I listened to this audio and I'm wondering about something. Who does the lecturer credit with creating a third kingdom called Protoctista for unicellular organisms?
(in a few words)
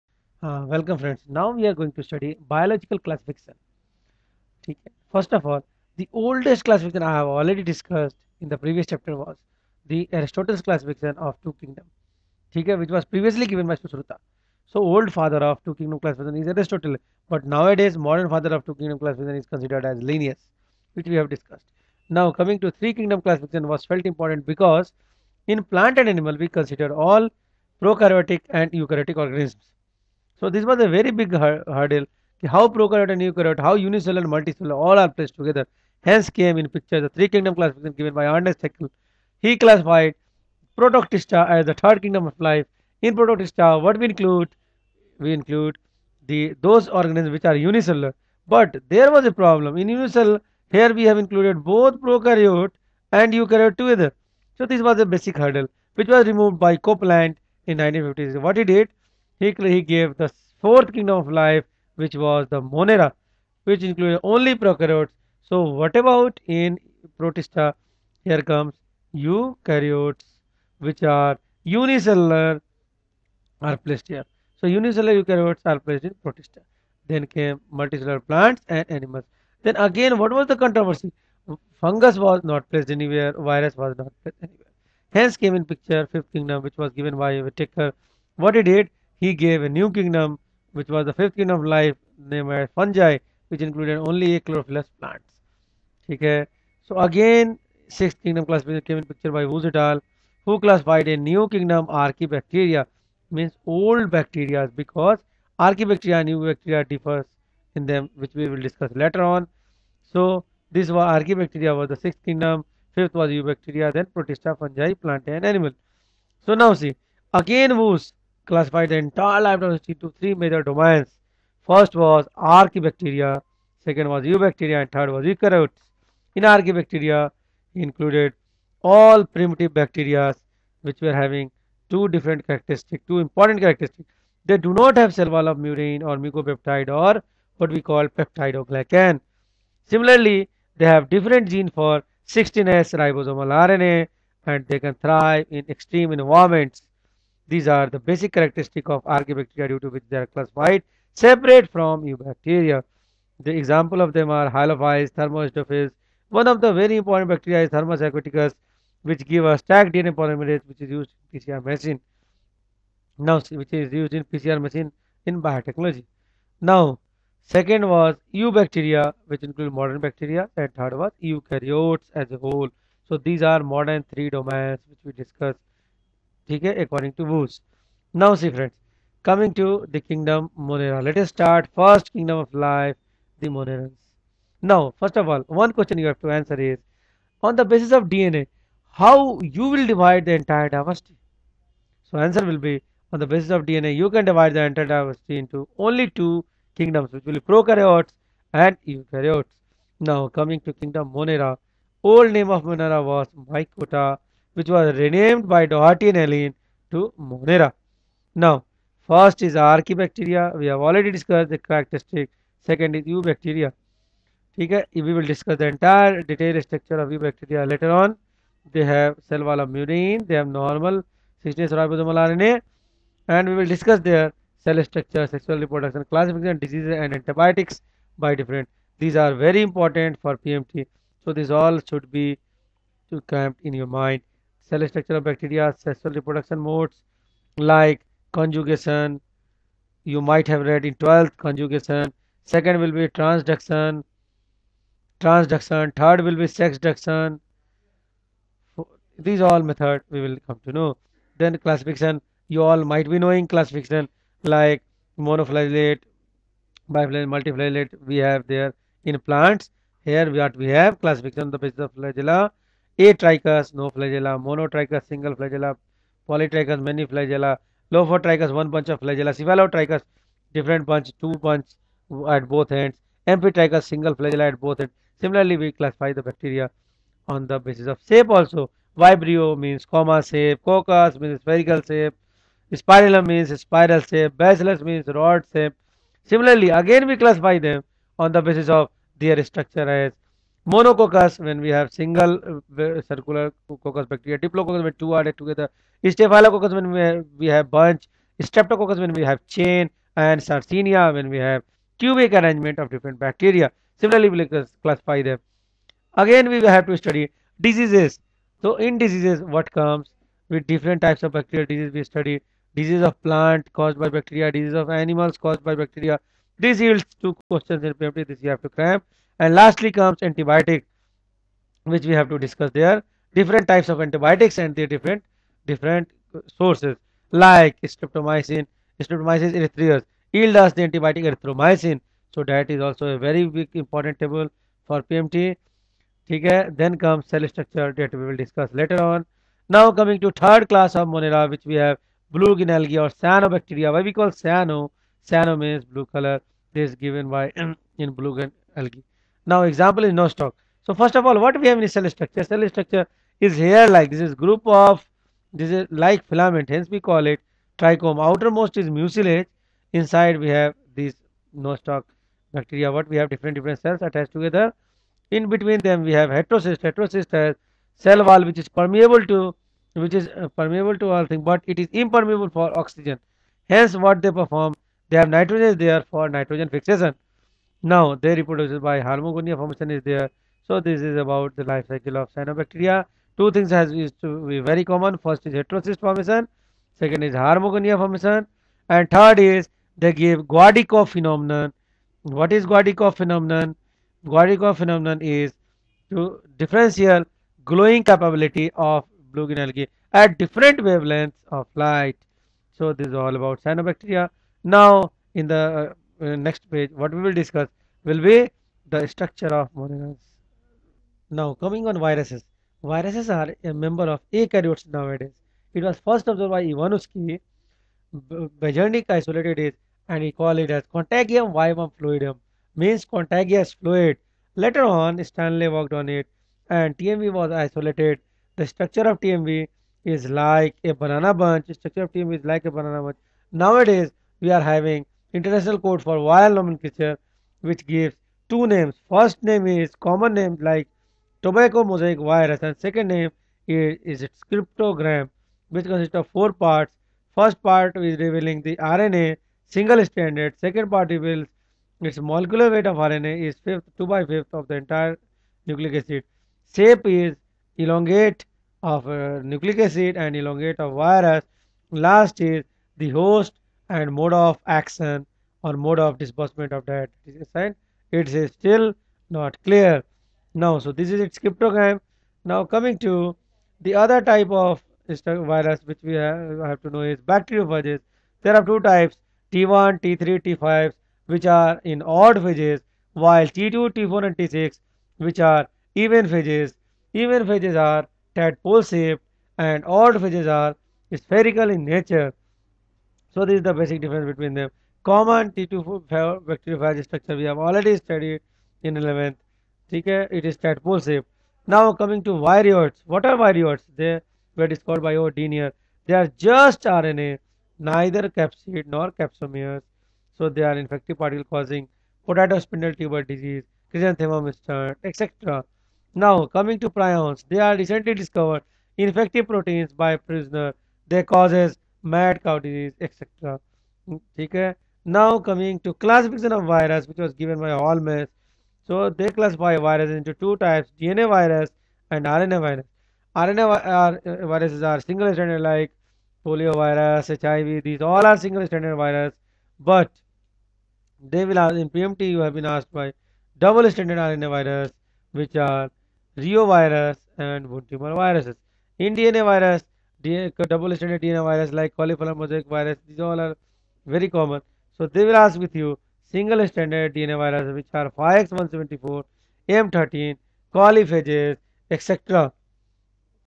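Ernest Haeckel.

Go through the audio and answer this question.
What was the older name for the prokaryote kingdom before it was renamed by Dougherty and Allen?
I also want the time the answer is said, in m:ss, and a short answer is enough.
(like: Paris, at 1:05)
Mychota, at 3:23.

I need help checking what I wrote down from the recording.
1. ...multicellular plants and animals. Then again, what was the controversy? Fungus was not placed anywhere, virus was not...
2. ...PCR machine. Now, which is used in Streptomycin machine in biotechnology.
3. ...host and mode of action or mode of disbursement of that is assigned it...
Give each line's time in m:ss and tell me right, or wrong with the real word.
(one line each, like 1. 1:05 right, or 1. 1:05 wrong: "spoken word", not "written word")
1. 1:17 right
2. 2:41 wrong: "PCR", not "Streptomycin"
3. 7:43 right.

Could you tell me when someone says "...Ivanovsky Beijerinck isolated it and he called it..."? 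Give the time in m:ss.
6:56.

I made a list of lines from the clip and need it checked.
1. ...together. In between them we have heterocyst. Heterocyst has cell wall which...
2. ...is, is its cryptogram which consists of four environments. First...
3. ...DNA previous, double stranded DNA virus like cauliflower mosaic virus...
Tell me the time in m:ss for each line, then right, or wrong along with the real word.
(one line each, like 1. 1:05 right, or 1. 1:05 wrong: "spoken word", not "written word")
1. 6:04 right
2. 7:23 wrong: "parts", not "environments"
3. 9:09 wrong: "virus", not "previous".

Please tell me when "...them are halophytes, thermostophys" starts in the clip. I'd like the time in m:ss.
2:34.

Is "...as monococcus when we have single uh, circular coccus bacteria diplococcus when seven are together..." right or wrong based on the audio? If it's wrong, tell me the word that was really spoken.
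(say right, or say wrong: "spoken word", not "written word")
wrong: "two", not "seven".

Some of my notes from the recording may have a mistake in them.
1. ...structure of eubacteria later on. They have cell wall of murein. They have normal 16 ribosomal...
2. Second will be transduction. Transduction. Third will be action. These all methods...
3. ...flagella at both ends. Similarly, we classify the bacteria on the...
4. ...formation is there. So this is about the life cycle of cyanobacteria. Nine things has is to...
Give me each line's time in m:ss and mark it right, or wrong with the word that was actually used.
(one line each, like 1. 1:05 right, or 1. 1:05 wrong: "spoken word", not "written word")
1. 3:36 right
2. 4:02 wrong: "sexduction", not "action"
3. 4:34 right
4. 6:19 wrong: "Two", not "Nine".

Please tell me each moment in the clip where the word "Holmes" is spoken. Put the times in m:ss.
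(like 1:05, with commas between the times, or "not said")
8:47.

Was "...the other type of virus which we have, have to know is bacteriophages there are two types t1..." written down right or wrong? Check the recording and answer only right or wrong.
right.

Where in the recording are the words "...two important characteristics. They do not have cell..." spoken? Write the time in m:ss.
2:13.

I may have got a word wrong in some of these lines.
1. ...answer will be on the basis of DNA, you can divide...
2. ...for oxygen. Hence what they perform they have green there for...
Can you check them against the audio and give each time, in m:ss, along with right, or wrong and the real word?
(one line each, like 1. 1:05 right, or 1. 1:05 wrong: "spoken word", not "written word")
1. 3:12 right
2. 6:12 wrong: "nitrogen", not "green".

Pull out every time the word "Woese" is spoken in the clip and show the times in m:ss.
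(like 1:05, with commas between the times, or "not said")
1:39, 1:57.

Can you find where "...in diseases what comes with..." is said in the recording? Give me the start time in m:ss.
5:08.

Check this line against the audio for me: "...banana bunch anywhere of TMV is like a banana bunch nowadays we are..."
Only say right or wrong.
wrong.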